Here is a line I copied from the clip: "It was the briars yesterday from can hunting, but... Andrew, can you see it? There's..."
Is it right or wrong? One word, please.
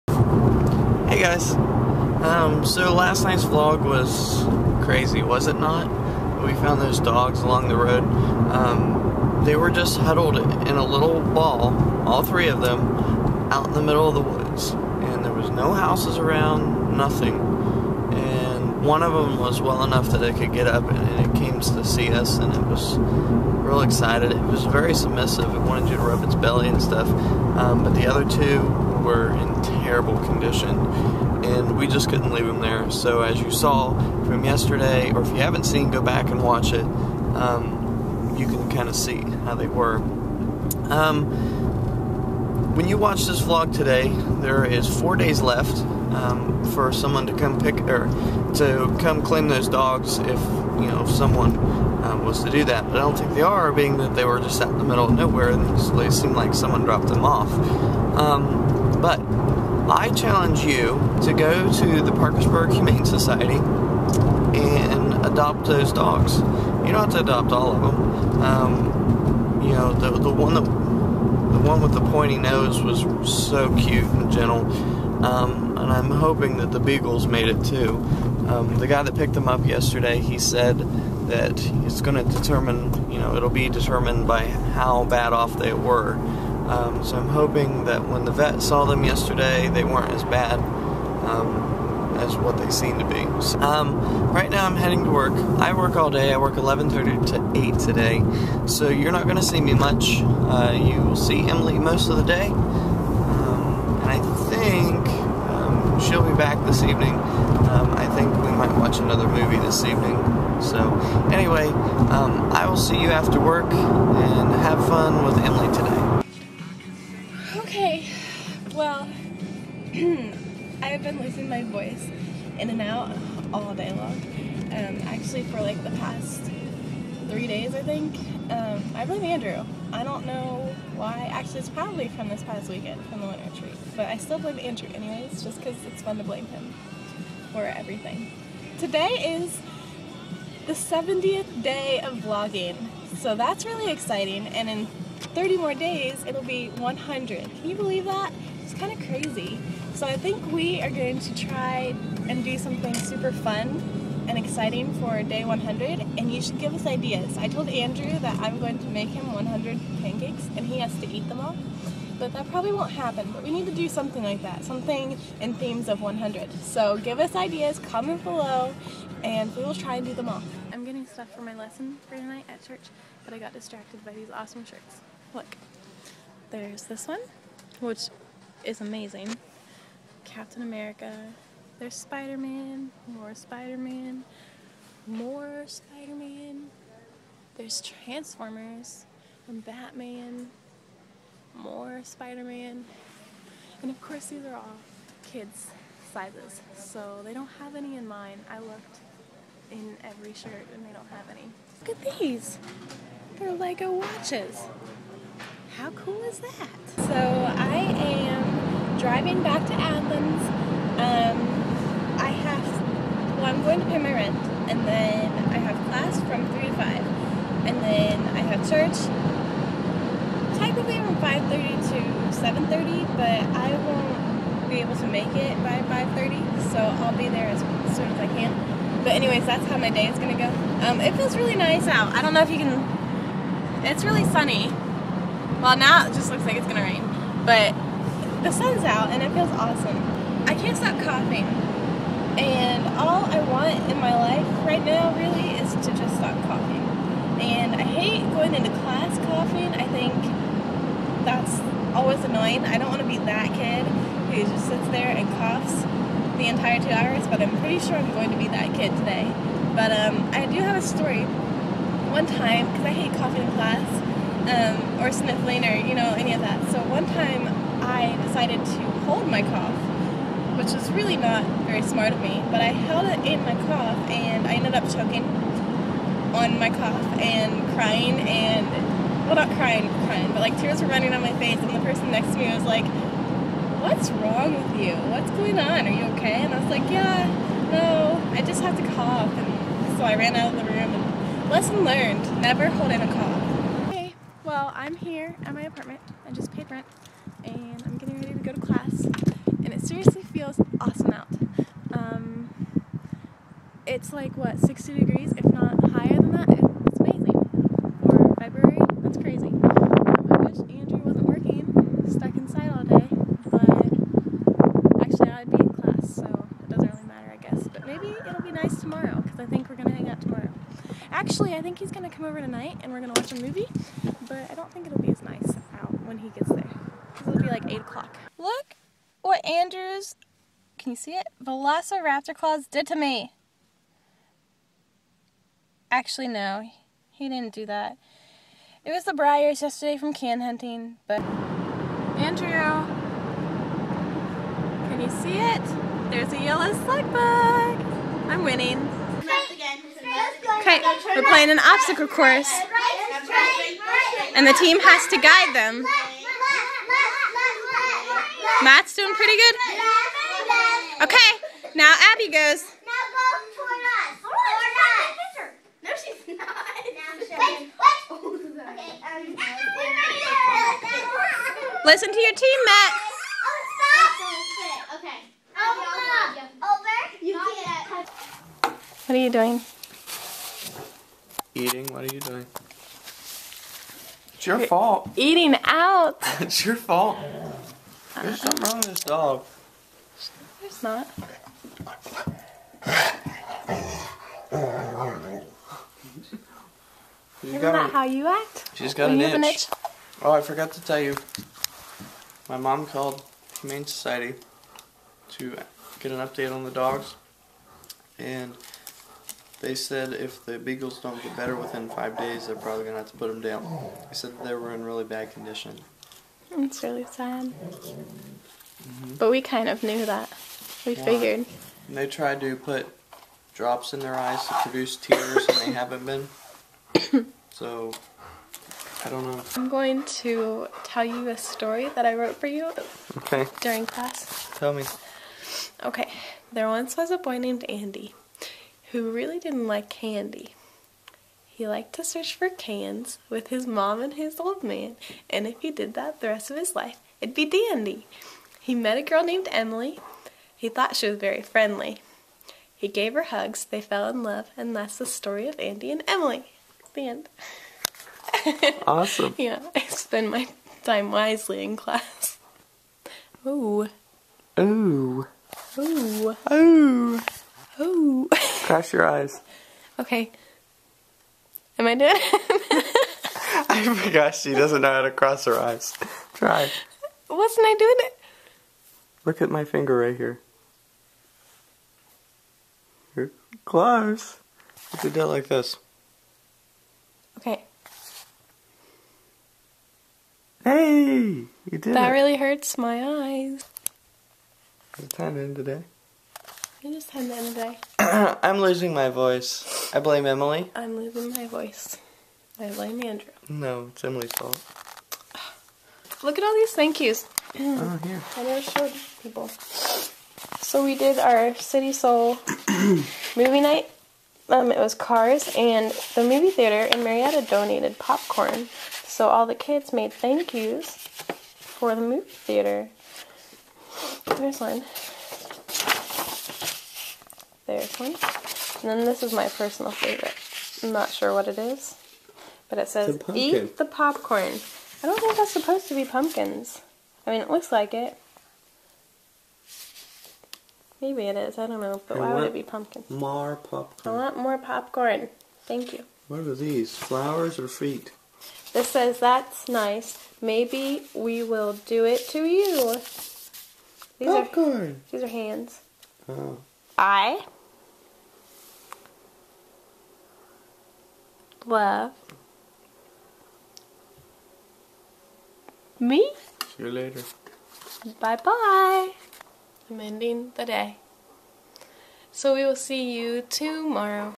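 right.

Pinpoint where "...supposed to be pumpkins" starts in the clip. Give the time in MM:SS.
08:55.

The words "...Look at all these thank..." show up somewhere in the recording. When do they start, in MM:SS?
08:26.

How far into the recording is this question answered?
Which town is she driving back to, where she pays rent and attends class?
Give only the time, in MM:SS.
03:29.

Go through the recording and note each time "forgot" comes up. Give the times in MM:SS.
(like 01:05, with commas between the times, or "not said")
06:40, 07:53.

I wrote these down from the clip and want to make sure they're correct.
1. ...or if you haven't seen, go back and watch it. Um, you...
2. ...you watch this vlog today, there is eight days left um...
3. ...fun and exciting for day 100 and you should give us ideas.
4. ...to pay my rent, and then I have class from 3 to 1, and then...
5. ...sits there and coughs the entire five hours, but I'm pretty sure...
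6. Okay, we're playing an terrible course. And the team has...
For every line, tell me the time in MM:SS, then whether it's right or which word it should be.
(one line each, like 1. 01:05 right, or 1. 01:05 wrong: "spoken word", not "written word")
1. 00:35 right
2. 00:42 wrong: "four", not "eight"
3. 02:33 right
4. 03:33 wrong: "5", not "1"
5. 04:14 wrong: "two", not "five"
6. 05:50 wrong: "obstacle", not "terrible".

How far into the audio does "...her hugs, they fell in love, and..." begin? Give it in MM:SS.
07:33.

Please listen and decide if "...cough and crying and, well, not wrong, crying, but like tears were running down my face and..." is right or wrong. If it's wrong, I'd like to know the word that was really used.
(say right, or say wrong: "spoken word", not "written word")
wrong: "crying", not "wrong".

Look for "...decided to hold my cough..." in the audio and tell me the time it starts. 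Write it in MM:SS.
04:28.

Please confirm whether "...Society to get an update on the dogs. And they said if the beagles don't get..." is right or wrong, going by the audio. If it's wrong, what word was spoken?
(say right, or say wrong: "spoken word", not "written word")
right.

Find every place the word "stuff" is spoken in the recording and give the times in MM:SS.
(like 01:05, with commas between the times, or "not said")
00:26, 02:51.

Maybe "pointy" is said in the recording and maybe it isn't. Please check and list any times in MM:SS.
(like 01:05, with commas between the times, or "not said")
01:12.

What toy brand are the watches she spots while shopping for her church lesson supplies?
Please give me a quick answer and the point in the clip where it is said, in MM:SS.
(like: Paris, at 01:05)
Lego, at 03:23.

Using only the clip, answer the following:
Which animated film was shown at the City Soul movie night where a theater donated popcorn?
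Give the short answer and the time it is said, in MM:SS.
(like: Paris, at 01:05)
Cars, at 08:34.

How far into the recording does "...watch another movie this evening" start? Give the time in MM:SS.
01:48.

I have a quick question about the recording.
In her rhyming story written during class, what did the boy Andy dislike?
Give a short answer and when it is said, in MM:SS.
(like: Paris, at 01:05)
candy, at 07:20.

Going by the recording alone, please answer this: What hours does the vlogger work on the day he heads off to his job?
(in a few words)
11:30 to 8.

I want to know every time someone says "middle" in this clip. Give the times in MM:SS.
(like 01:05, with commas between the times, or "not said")
00:13, 00:54.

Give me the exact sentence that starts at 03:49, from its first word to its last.
But anyways, that's how my day is going to go.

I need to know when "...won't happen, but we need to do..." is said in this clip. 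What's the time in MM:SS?
02:42.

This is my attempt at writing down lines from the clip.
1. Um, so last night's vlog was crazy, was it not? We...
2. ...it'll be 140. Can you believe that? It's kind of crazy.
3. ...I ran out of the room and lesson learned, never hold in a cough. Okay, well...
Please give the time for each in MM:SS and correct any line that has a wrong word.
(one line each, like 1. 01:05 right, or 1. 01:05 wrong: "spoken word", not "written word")
1. 00:01 right
2. 02:26 wrong: "100", not "140"
3. 04:50 right.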